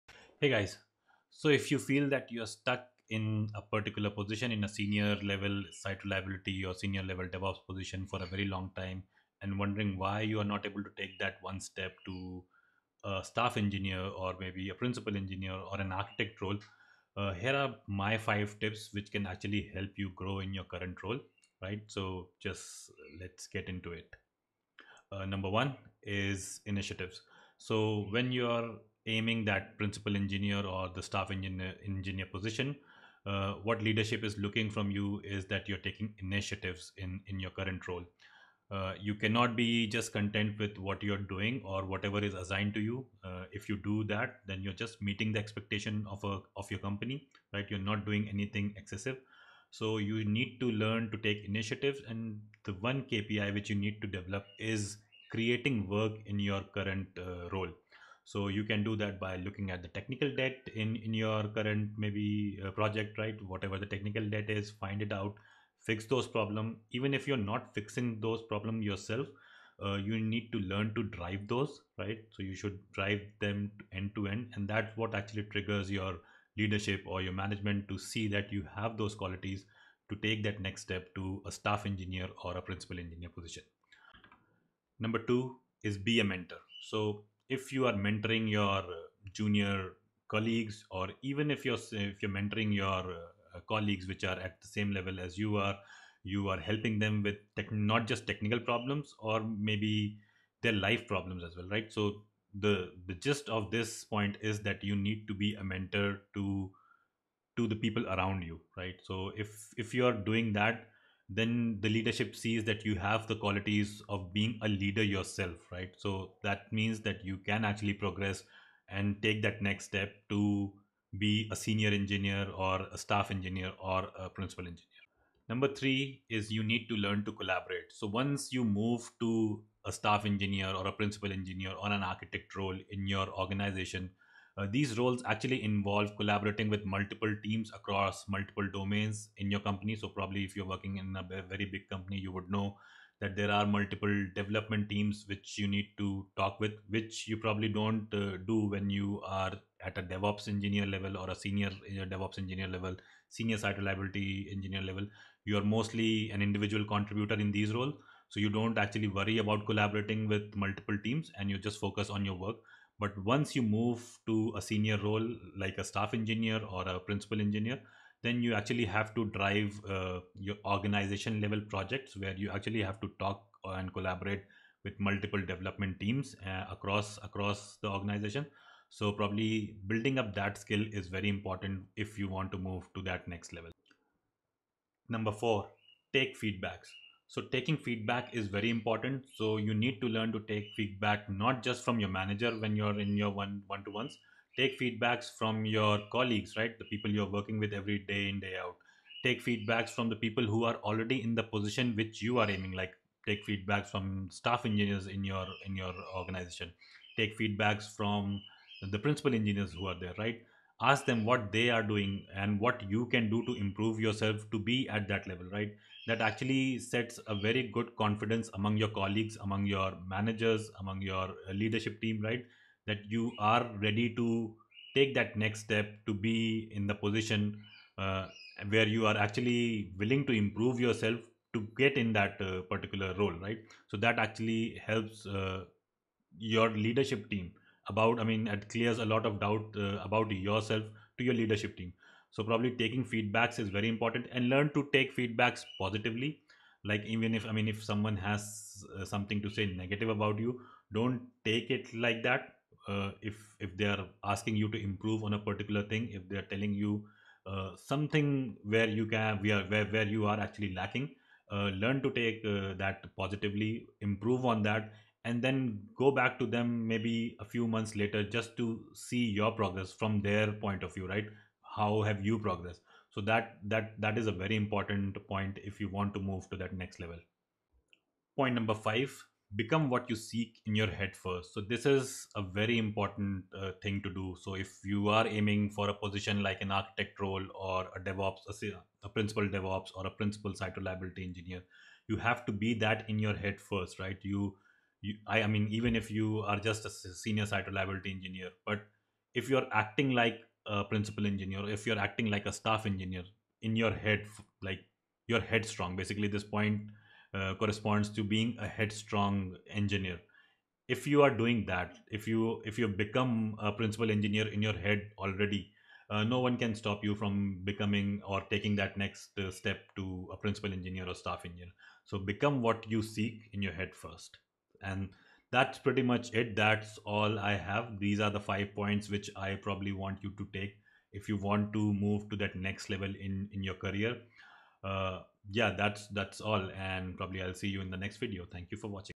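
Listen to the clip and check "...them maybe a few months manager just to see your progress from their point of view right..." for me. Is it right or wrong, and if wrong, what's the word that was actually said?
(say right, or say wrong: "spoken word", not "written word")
wrong: "later", not "manager".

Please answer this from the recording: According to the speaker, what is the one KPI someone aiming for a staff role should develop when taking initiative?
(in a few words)
Creating work.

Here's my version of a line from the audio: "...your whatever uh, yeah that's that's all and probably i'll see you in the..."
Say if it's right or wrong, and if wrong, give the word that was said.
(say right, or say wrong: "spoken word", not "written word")
wrong: "career", not "whatever".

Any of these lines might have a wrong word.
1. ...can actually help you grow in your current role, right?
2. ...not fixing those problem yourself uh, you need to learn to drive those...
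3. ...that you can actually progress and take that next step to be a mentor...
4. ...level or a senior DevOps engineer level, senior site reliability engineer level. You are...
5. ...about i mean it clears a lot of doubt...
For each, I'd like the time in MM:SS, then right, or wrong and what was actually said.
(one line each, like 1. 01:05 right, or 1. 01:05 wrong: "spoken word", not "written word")
1. 00:19 right
2. 01:07 right
3. 01:57 wrong: "senior", not "mentor"
4. 02:30 right
5. 03:57 right.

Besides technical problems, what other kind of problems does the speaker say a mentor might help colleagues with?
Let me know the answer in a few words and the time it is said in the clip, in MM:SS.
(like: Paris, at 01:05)
Life problems, at 01:40.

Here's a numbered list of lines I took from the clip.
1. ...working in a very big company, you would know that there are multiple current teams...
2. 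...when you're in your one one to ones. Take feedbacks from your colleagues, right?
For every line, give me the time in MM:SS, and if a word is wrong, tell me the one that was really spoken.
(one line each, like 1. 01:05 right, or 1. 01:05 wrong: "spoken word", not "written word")
1. 02:20 wrong: "development", not "current"
2. 03:12 right.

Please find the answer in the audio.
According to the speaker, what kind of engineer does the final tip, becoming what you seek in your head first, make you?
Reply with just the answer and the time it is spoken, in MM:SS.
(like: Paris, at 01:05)
Headstrong engineer, at 05:08.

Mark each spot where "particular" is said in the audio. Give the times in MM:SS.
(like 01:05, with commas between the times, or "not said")
00:03, 03:52, 04:15.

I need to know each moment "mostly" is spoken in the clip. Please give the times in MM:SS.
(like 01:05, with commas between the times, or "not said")
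02:35.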